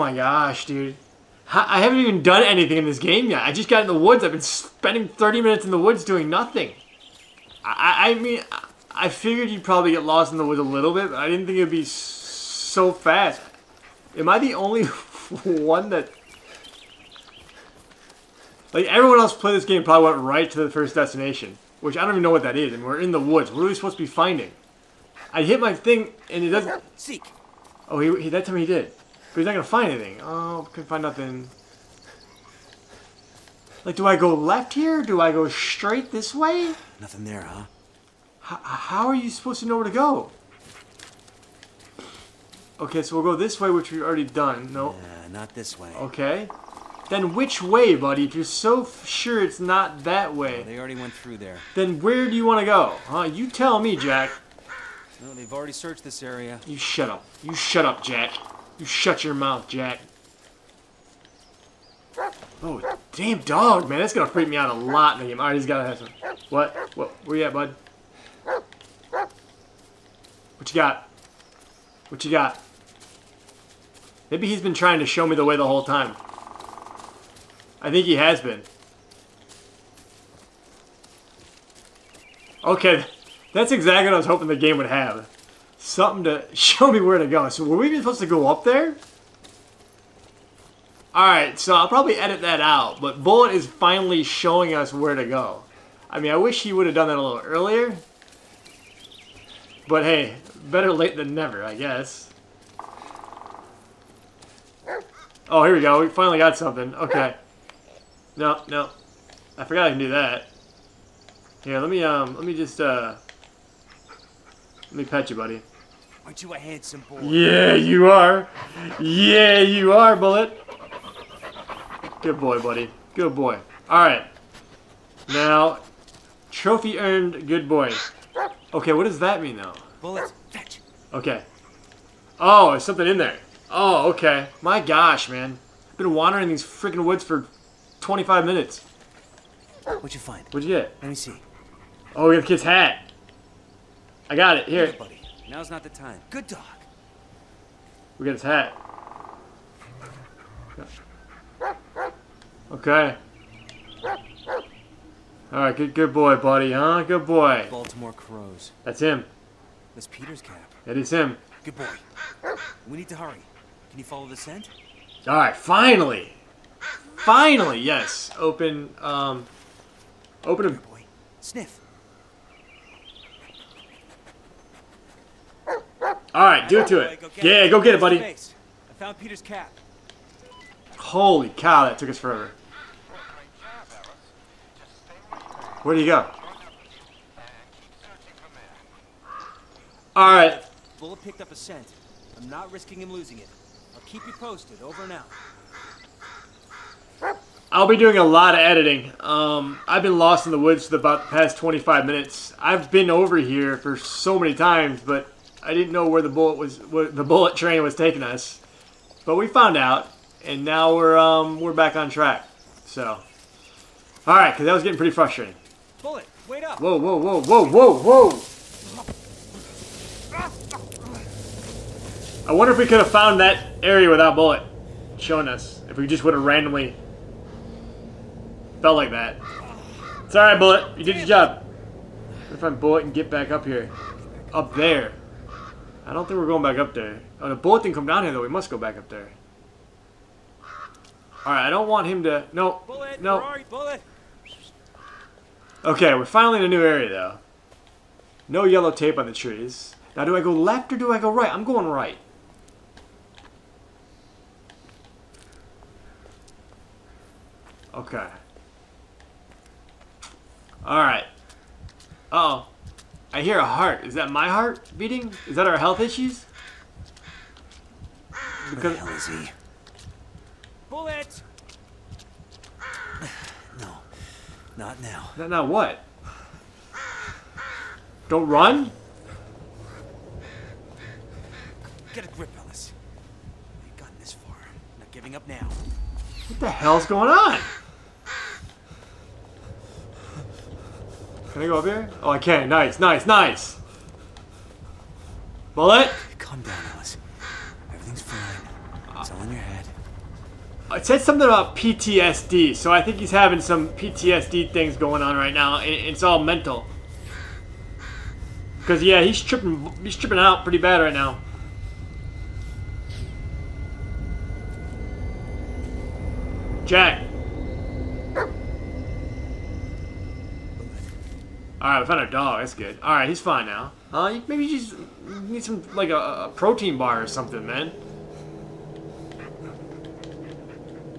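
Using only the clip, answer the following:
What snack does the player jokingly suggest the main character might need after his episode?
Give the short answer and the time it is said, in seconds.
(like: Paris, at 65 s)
A protein bar, at 326 s.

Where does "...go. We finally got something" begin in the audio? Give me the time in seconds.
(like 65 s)
105 s.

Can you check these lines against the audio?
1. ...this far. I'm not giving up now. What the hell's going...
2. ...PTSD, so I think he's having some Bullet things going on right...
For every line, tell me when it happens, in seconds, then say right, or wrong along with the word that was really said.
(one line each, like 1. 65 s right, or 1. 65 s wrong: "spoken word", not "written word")
1. 284 s right
2. 301 s wrong: "PTSD", not "Bullet".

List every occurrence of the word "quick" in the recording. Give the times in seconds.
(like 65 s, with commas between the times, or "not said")
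not said.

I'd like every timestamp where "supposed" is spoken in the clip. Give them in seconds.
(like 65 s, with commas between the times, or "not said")
23 s, 39 s, 88 s.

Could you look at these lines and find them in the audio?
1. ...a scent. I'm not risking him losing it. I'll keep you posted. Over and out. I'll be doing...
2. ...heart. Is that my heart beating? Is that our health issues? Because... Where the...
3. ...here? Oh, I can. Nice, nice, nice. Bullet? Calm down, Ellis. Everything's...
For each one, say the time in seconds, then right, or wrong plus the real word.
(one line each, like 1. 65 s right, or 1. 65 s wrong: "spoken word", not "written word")
1. 191 s right
2. 263 s right
3. 291 s right.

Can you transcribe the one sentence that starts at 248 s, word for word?
No yellow tape on the trees.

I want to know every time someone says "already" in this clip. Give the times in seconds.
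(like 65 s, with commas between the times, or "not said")
44 s, 50 s, 55 s.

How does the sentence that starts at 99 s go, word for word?
But hey, better late than never, I guess.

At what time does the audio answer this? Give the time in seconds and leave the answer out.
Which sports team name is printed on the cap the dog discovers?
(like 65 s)
157 s.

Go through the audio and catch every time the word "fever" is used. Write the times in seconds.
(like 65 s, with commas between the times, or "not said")
not said.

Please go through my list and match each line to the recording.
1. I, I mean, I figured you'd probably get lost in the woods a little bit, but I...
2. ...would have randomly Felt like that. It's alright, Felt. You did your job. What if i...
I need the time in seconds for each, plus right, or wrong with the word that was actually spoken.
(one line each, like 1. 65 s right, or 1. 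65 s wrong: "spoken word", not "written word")
1. 7 s right
2. 226 s wrong: "Bullet", not "Felt".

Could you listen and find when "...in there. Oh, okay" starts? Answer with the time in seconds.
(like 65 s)
133 s.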